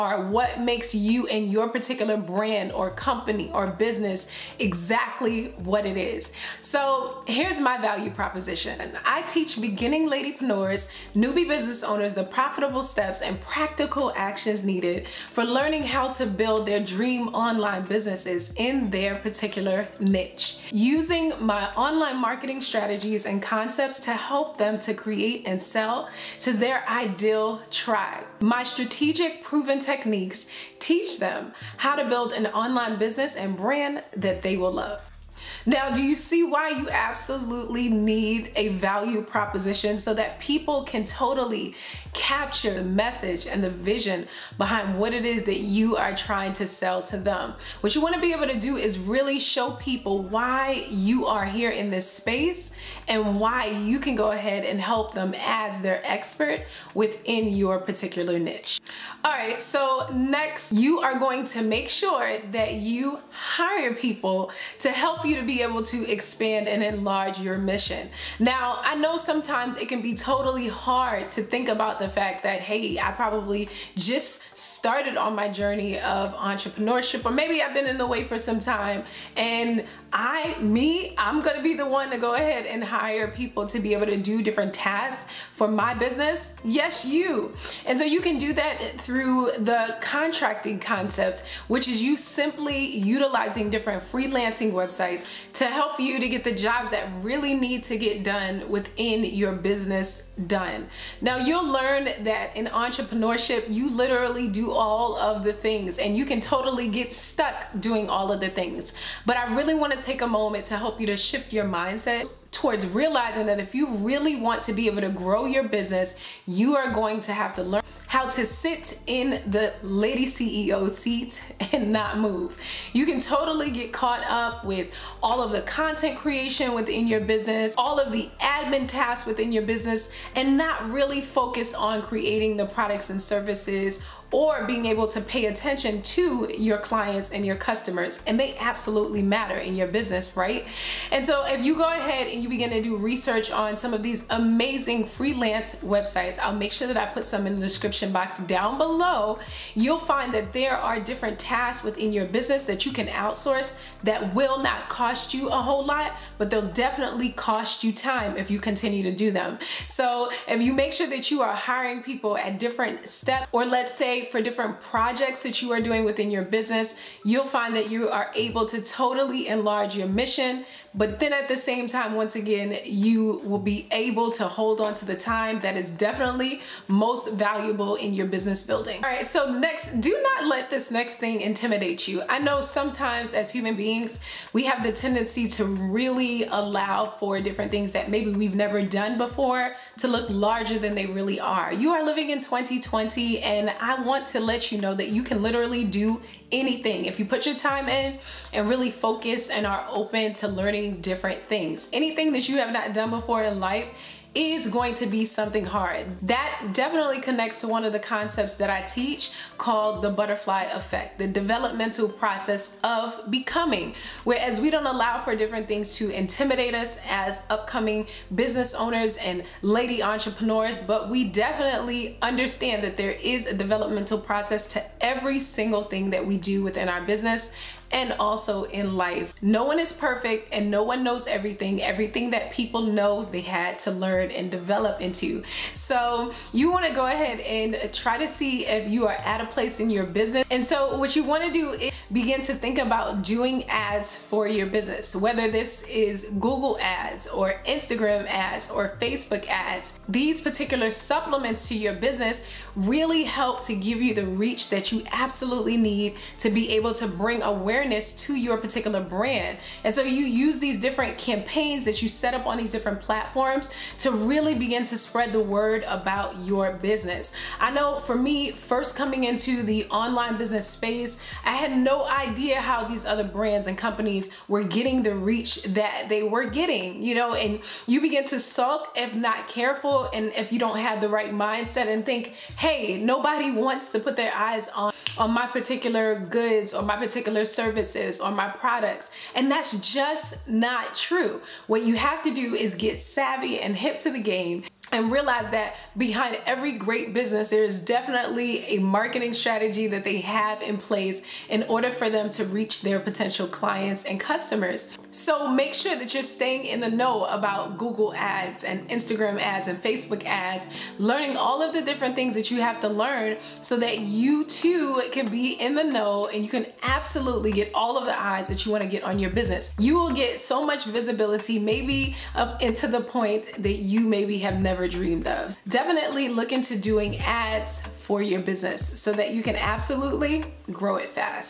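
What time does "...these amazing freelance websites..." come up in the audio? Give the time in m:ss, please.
2:24.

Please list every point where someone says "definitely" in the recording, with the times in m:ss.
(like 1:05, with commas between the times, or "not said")
2:36, 2:55, 3:26, 3:41, 4:57, 5:25.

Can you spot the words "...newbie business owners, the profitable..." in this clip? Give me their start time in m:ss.
0:11.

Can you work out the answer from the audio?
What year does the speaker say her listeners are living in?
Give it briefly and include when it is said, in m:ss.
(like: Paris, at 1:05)
2020, at 3:12.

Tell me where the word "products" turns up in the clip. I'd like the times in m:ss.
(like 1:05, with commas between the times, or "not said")
2:12, 4:48.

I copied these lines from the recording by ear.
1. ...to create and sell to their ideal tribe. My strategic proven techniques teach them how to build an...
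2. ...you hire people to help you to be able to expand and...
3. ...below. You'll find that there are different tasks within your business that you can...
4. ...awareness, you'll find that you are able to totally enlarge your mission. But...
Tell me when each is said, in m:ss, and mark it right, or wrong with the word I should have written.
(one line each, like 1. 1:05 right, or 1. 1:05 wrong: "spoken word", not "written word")
1. 0:24 right
2. 1:02 right
3. 2:28 right
4. 2:46 wrong: "business", not "awareness".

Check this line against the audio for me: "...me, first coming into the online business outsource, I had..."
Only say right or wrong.
wrong.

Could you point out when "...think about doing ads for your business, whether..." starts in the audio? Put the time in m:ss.
4:02.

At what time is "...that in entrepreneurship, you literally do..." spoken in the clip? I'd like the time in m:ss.
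1:42.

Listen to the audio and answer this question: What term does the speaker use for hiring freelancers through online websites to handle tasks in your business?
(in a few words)
Contracting concept.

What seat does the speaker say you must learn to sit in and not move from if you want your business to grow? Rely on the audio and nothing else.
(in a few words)
Lady CEO seat.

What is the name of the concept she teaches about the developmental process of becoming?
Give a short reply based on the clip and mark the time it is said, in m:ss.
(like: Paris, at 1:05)
The butterfly effect, at 3:30.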